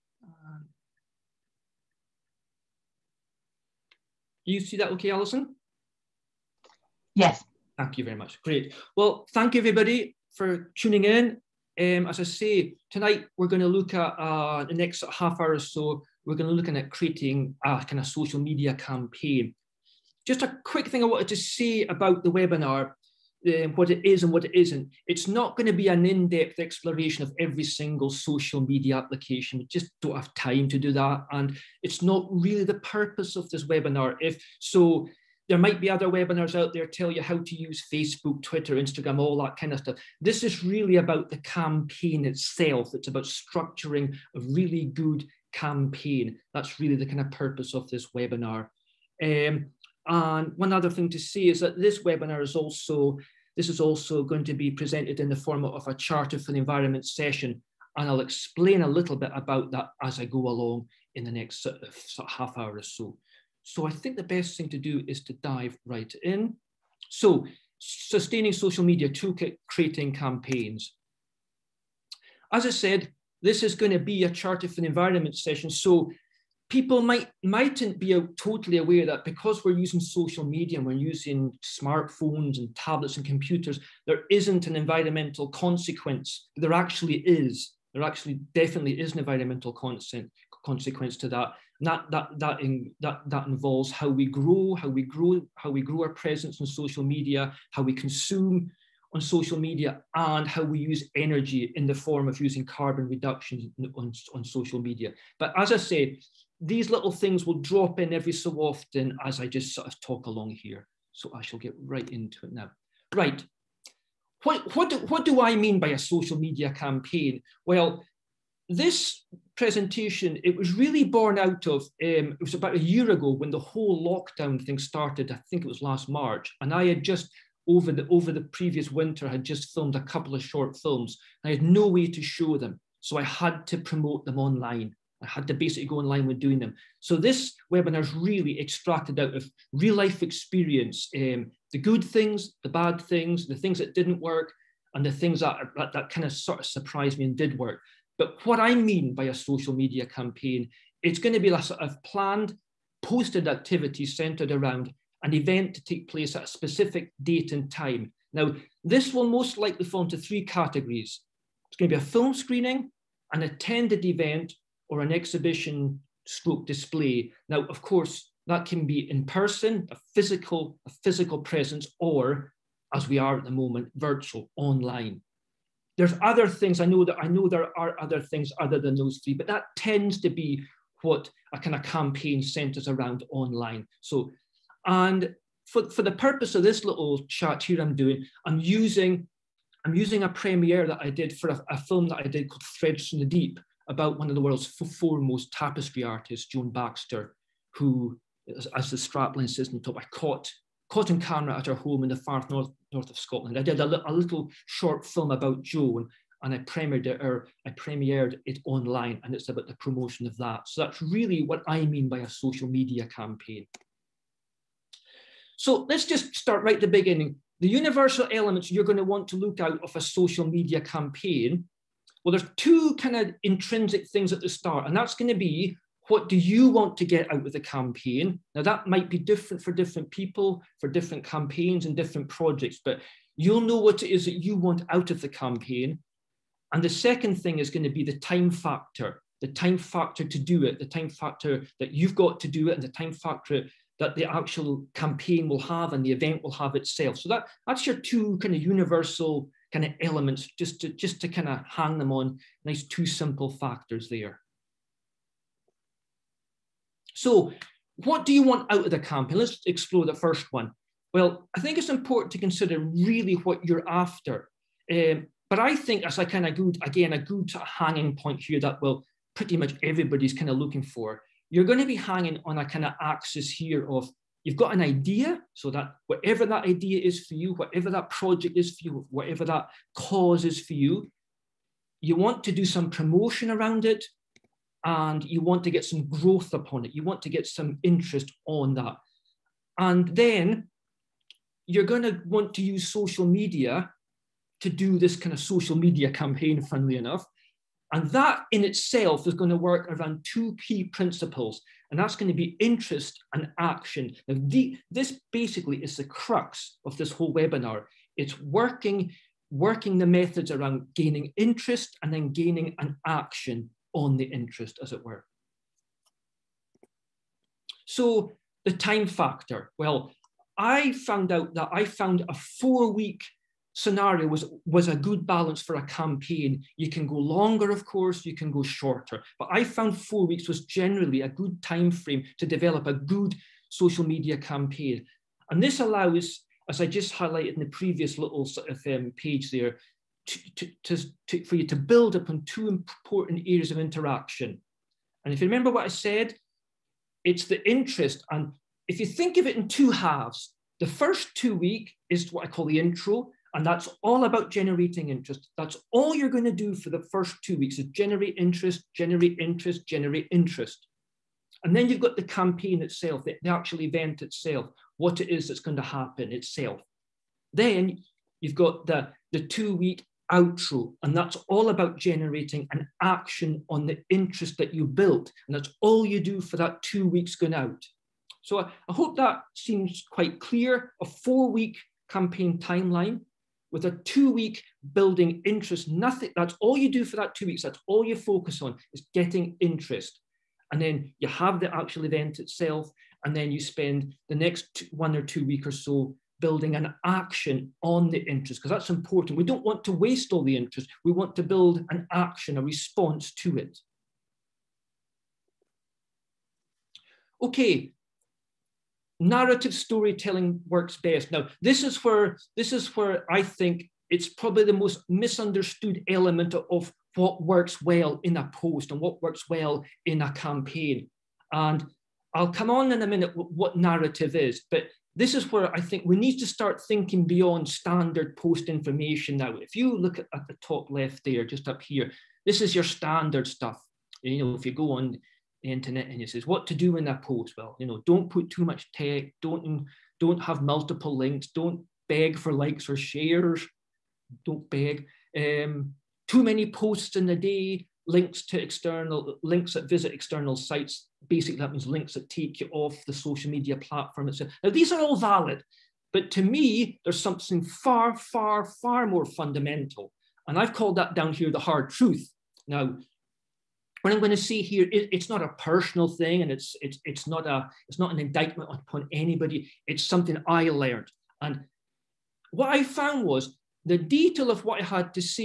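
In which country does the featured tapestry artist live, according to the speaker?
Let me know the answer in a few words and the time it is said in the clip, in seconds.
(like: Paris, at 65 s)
Scotland, at 203 s.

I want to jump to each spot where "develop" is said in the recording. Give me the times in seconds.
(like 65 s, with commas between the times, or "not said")
332 s.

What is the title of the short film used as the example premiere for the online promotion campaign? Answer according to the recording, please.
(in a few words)
Threads from the Deep.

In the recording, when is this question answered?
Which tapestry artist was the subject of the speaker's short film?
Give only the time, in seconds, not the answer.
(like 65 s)
196 s.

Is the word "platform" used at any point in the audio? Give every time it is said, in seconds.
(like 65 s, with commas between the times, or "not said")
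453 s.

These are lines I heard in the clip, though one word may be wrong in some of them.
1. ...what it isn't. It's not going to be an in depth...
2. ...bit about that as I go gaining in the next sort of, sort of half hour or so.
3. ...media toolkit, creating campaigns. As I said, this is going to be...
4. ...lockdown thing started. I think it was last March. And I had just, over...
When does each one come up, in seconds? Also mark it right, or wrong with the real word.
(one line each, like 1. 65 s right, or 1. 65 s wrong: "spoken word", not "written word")
1. 24 s right
2. 59 s wrong: "along", not "gaining"
3. 68 s right
4. 124 s right.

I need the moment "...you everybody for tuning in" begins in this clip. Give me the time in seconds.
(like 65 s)
9 s.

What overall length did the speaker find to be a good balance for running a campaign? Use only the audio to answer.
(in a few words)
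4 weeks.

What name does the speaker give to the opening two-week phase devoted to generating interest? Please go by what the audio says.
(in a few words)
the intro.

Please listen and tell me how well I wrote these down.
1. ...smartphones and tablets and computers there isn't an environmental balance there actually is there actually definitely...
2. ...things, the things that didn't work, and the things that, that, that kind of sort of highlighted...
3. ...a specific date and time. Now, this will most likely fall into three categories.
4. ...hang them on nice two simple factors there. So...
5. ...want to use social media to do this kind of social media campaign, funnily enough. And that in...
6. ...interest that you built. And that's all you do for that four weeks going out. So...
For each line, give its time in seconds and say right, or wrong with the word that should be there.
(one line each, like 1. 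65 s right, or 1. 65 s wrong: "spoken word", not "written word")
1. 81 s wrong: "consequence", not "balance"
2. 143 s wrong: "surprised", not "highlighted"
3. 156 s right
4. 251 s right
5. 292 s right
6. 374 s wrong: "two", not "four".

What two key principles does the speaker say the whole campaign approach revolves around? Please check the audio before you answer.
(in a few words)
interest and action.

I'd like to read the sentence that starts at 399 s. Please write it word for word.
We don't want to waste all the interest, we want to build an action, a response to it.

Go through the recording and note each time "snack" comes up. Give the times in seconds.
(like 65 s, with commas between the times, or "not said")
not said.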